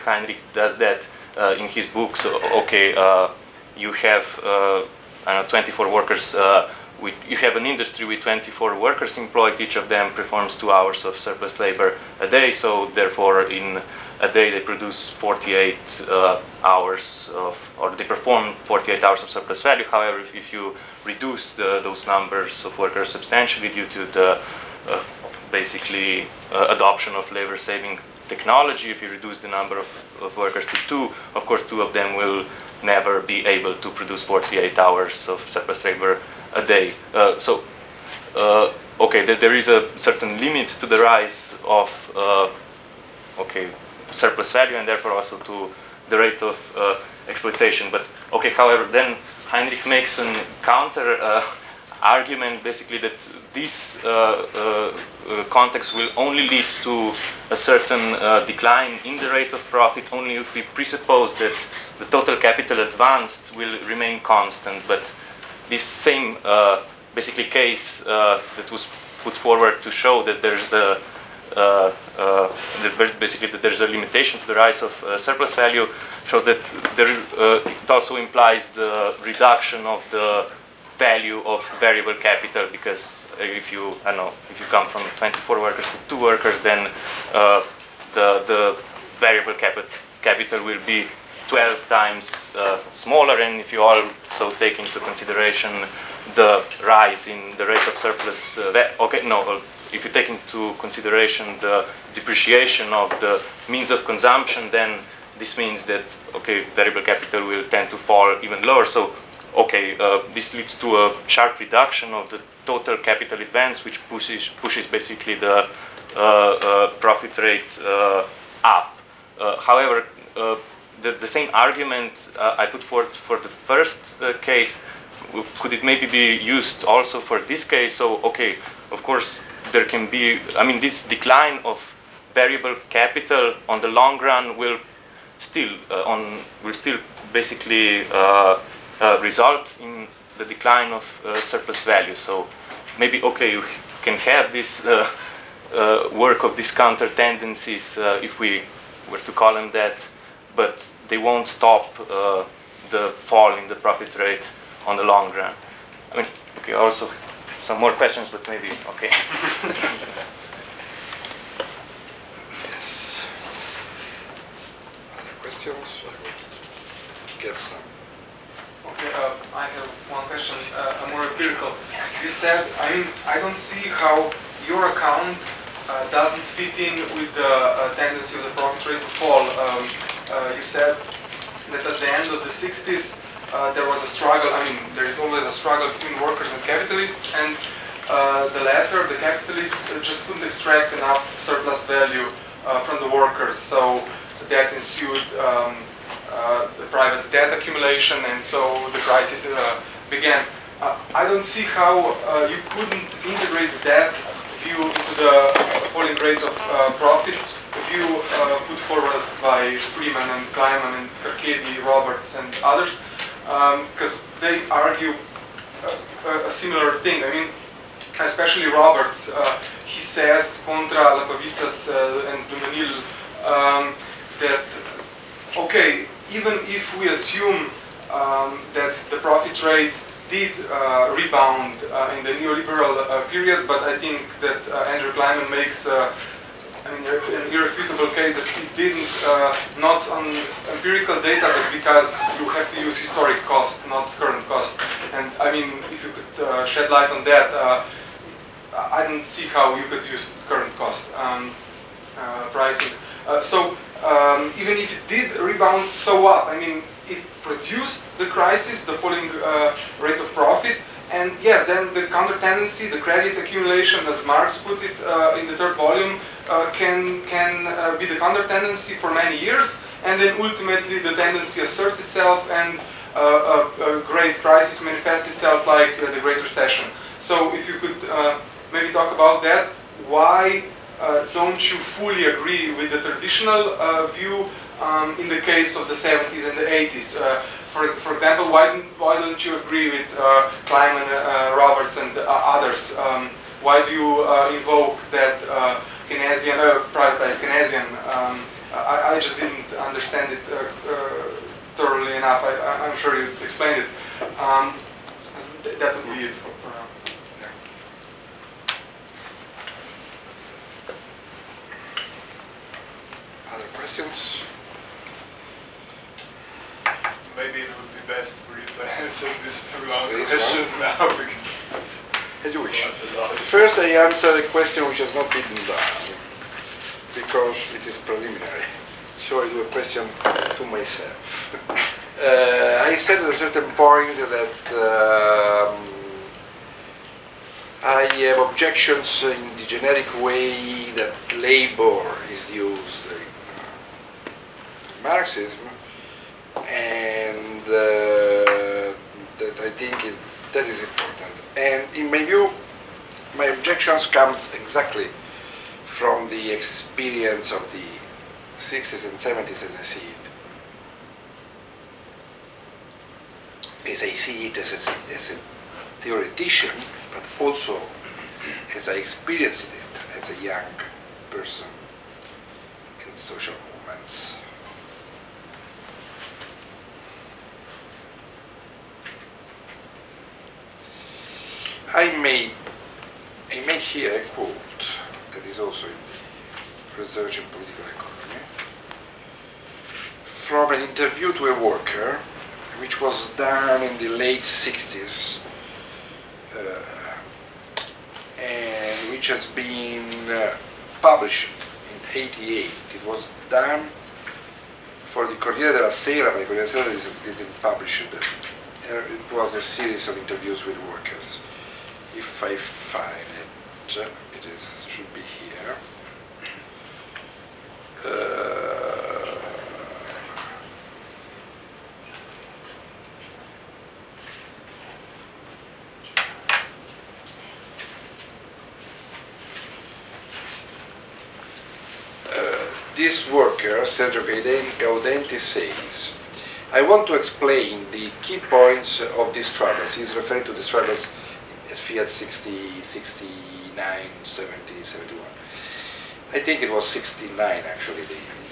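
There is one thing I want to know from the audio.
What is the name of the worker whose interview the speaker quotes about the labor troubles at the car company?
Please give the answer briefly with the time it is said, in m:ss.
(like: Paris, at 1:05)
Sergio Gaudenti, at 7:13.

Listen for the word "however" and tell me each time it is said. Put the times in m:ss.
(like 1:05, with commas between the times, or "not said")
0:19, 0:48, 1:59.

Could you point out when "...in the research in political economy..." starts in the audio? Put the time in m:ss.
6:25.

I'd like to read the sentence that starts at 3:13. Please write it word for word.
So that ensued um, the private debt accumulation, and so the crisis began.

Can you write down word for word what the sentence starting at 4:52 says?
Um, why do you invoke that Keynesian, privatized Keynesian?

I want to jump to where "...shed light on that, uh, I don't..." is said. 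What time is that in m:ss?
4:06.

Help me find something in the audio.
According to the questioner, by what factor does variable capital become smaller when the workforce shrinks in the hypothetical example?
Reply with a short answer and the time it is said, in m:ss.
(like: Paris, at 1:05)
12, at 1:31.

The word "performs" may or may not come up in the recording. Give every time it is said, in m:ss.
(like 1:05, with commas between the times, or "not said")
0:10, 0:18.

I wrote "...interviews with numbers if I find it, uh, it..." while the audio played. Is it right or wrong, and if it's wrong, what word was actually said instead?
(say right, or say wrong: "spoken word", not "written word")
wrong: "workers", not "numbers".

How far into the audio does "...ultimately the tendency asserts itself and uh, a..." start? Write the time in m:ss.
4:30.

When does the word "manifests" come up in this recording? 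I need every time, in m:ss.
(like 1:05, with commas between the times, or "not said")
4:34.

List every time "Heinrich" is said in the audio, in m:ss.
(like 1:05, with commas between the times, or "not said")
0:00, 0:49.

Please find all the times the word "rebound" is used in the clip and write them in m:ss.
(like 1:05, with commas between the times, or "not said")
3:51, 4:15.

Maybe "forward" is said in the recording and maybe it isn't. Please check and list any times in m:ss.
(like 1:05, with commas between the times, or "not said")
1:09, 3:28.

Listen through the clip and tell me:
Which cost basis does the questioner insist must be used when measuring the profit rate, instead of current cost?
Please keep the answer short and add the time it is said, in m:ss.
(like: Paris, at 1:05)
historic cost, at 4:02.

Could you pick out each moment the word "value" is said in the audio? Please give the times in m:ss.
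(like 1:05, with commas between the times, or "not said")
0:19, 0:44, 1:15, 1:20, 2:21, 3:11.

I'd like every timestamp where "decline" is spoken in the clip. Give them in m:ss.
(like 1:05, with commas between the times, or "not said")
0:58, 2:11, 2:20.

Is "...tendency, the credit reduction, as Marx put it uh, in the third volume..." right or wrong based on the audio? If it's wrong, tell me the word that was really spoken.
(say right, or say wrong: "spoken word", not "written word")
wrong: "accumulation", not "reduction".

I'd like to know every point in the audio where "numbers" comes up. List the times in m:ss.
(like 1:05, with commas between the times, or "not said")
0:22, 0:29.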